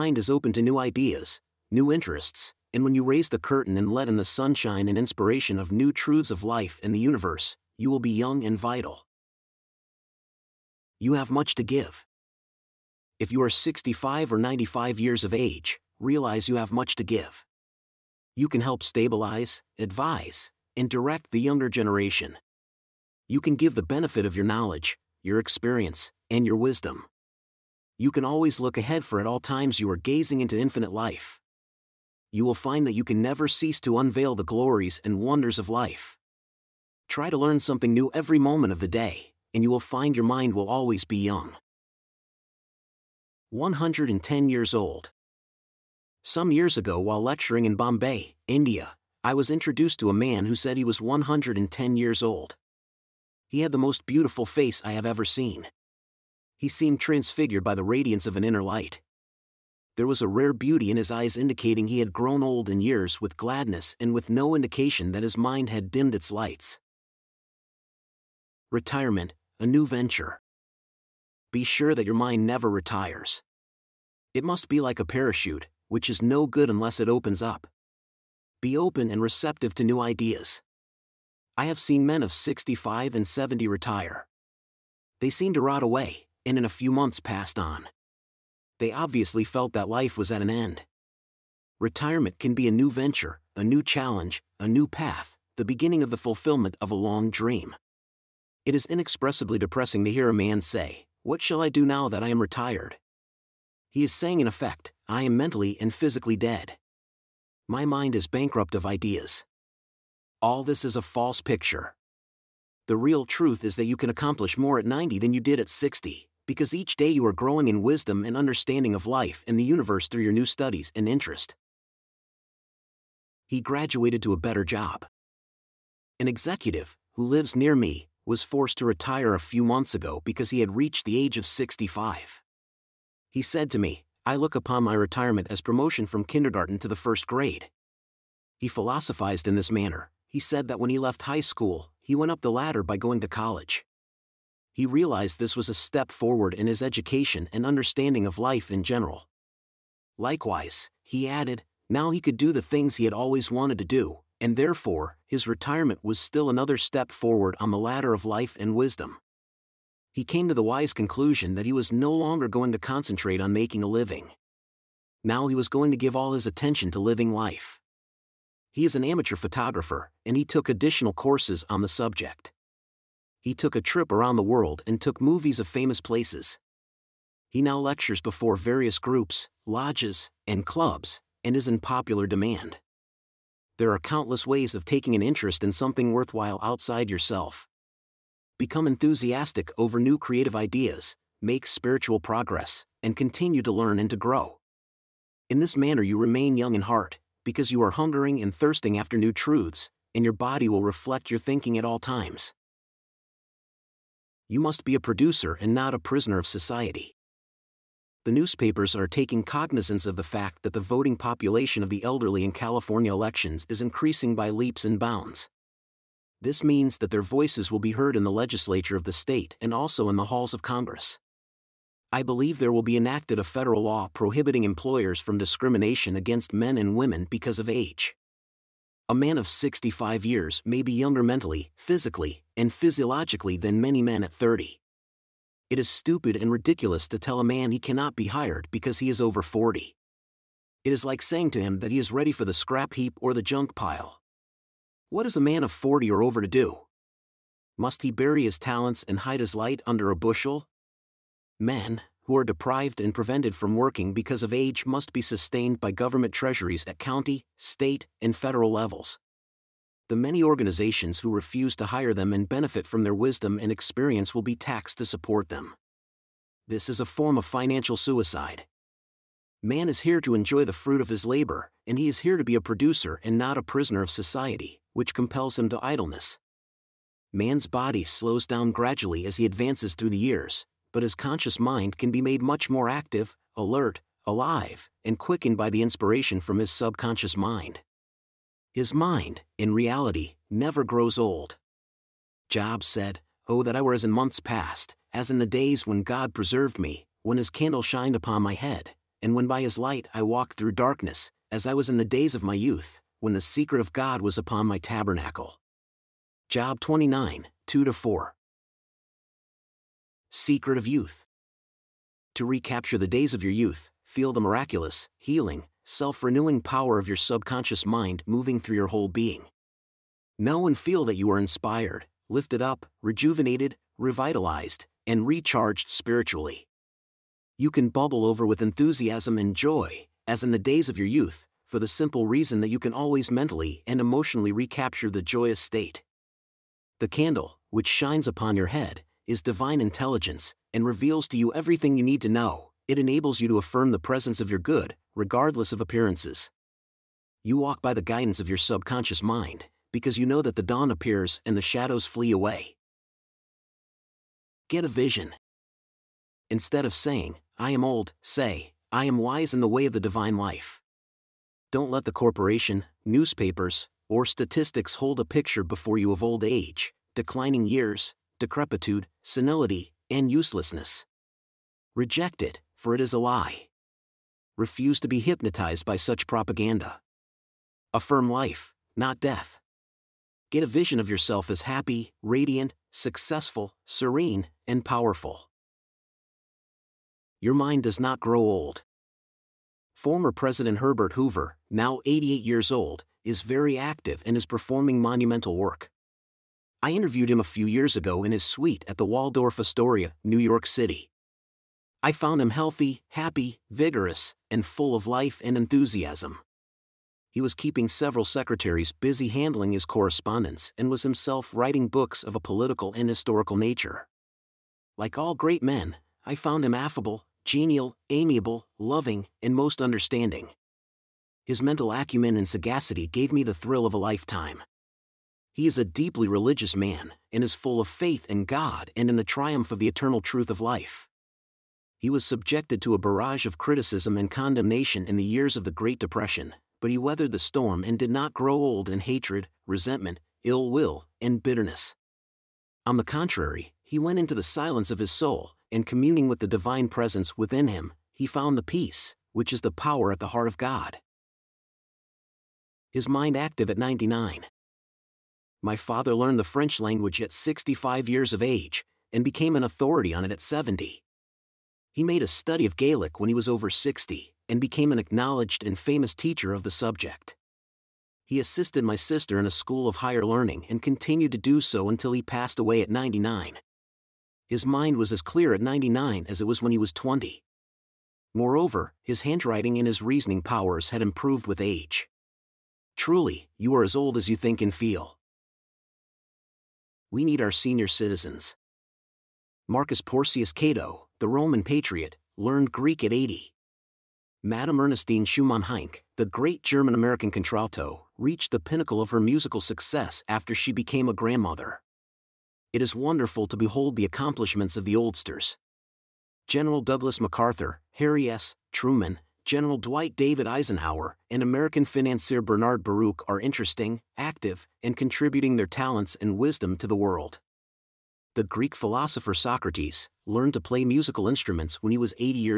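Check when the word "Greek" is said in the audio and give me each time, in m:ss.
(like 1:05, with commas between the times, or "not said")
8:12, 8:38.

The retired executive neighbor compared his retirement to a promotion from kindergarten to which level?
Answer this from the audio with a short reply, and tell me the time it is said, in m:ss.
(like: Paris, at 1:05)
First grade, at 2:16.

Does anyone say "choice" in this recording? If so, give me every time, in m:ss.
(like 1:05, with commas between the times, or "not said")
not said.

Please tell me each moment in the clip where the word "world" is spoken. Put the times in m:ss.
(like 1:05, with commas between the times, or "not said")
2:54, 8:36.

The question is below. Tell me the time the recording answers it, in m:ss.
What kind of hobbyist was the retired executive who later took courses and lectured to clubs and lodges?
2:49.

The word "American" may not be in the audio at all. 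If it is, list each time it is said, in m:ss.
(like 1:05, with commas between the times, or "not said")
8:16, 8:31.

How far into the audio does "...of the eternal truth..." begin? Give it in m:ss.
7:09.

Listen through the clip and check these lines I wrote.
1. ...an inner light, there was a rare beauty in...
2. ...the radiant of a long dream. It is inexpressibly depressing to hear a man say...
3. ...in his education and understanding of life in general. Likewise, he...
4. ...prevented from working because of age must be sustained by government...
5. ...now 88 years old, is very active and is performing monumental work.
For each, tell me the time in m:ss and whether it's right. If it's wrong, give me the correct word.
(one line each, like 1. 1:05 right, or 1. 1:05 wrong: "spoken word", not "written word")
1. 0:58 right
2. 1:36 wrong: "fulfillment", not "radiant"
3. 2:26 right
4. 4:13 right
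5. 6:31 right.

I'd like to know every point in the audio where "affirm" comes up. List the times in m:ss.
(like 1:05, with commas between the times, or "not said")
5:43, 6:17.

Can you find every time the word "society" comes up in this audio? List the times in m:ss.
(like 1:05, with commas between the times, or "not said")
3:26, 4:34.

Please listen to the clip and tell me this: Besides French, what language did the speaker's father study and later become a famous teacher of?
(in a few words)
Gaelic.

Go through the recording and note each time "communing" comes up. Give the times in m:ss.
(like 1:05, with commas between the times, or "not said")
7:25.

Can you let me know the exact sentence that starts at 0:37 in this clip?
Try to learn something new every moment of the day, and you will find your mind will always be young.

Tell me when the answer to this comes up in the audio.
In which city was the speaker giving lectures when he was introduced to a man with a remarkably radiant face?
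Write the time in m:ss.
0:47.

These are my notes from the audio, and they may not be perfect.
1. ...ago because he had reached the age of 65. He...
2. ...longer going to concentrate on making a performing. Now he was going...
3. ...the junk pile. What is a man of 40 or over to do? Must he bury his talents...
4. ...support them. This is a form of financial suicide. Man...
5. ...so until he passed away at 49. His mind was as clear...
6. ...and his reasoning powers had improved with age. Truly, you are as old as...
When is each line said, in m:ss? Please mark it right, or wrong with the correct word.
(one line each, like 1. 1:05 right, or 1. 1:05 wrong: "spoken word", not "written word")
1. 2:09 right
2. 2:42 wrong: "living", not "performing"
3. 4:03 right
4. 4:25 right
5. 7:51 wrong: "99", not "49"
6. 7:59 right.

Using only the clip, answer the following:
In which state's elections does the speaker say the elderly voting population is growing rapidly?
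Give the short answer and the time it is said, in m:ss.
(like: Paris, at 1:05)
California, at 3:32.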